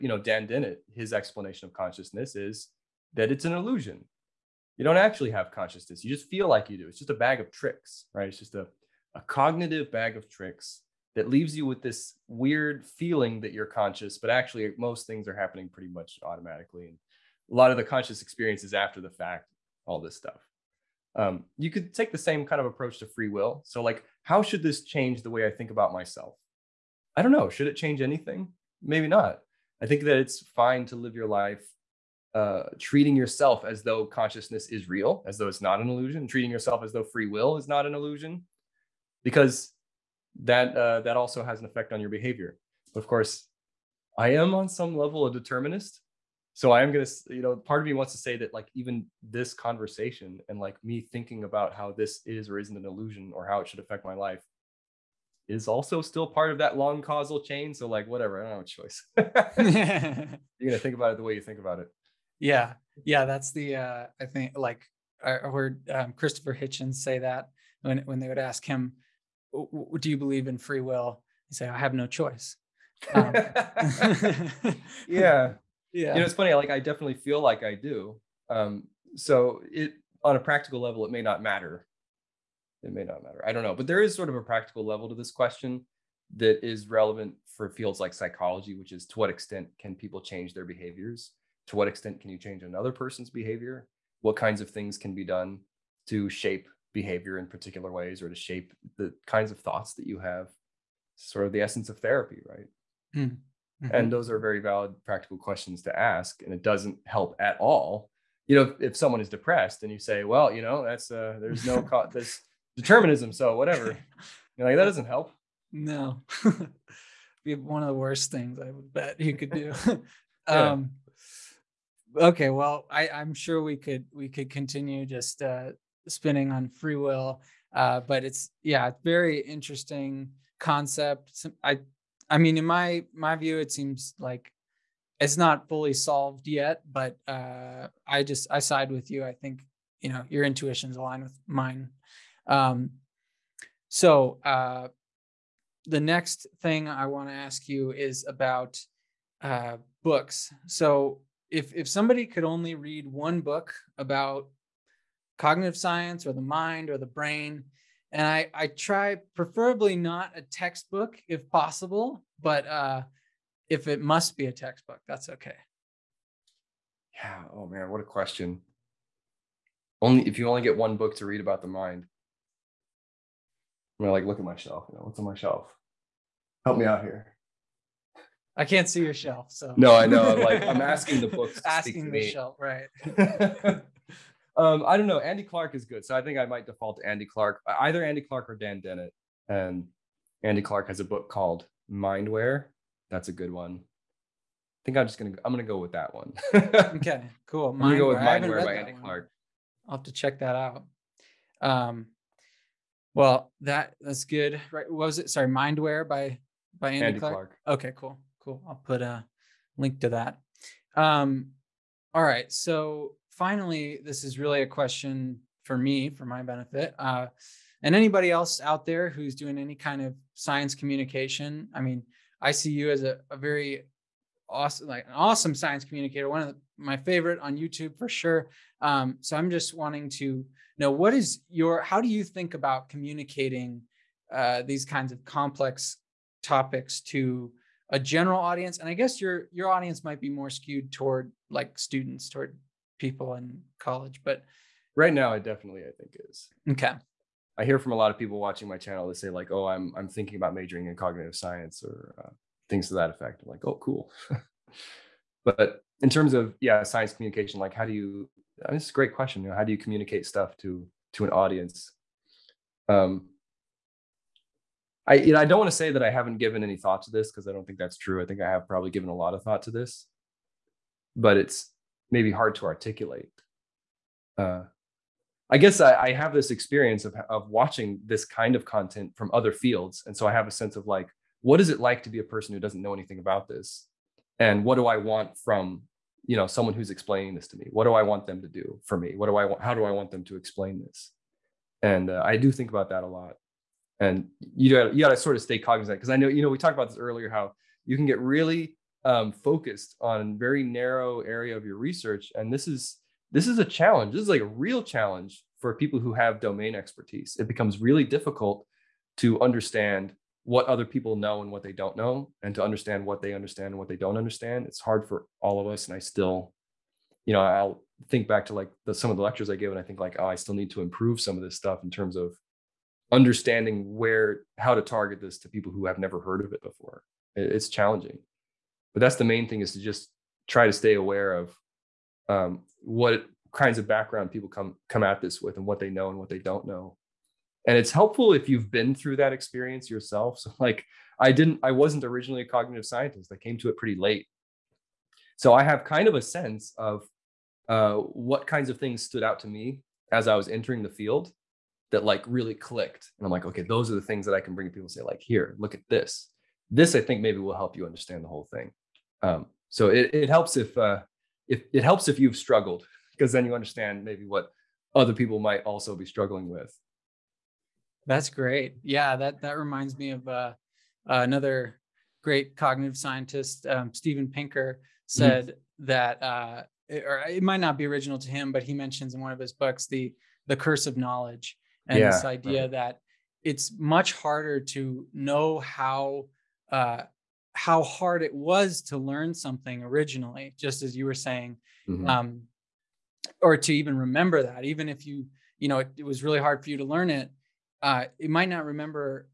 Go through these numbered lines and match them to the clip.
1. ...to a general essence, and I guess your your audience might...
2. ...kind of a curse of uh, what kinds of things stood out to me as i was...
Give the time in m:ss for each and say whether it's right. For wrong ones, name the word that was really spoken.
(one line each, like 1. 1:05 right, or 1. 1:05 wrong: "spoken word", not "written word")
1. 3:57 wrong: "audience", not "essence"
2. 5:45 wrong: "sense", not "curse".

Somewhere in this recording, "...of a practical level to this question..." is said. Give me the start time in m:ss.
1:24.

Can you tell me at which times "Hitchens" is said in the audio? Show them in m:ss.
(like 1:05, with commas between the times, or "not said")
1:06.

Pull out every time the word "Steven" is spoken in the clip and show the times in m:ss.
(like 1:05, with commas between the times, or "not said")
6:13.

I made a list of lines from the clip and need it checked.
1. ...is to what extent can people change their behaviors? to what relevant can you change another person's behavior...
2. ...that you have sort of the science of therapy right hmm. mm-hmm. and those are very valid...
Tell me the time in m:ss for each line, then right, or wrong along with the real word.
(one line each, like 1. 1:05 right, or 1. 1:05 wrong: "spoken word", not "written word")
1. 1:28 wrong: "extent", not "relevant"
2. 1:39 wrong: "essence", not "science".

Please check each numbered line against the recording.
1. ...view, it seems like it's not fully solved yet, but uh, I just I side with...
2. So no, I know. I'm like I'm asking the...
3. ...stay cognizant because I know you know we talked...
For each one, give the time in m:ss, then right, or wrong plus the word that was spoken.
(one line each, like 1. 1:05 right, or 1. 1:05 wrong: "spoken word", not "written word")
1. 2:13 right
2. 2:59 right
3. 4:55 right.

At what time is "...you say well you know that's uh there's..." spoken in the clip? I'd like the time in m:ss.
1:49.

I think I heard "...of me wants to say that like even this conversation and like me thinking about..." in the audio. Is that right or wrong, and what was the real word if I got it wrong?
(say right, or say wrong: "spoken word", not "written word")
right.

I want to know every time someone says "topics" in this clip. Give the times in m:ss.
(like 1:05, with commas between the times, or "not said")
3:56.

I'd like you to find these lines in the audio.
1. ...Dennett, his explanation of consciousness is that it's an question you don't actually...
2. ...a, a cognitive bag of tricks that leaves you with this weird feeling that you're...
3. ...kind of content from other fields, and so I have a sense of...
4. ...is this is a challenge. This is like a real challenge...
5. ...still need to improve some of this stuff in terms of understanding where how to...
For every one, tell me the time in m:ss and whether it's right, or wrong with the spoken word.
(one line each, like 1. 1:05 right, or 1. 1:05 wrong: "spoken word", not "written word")
1. 0:00 wrong: "illusion", not "question"
2. 0:08 right
3. 4:38 right
4. 5:02 right
5. 5:20 right.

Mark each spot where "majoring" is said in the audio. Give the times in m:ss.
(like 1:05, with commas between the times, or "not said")
4:10.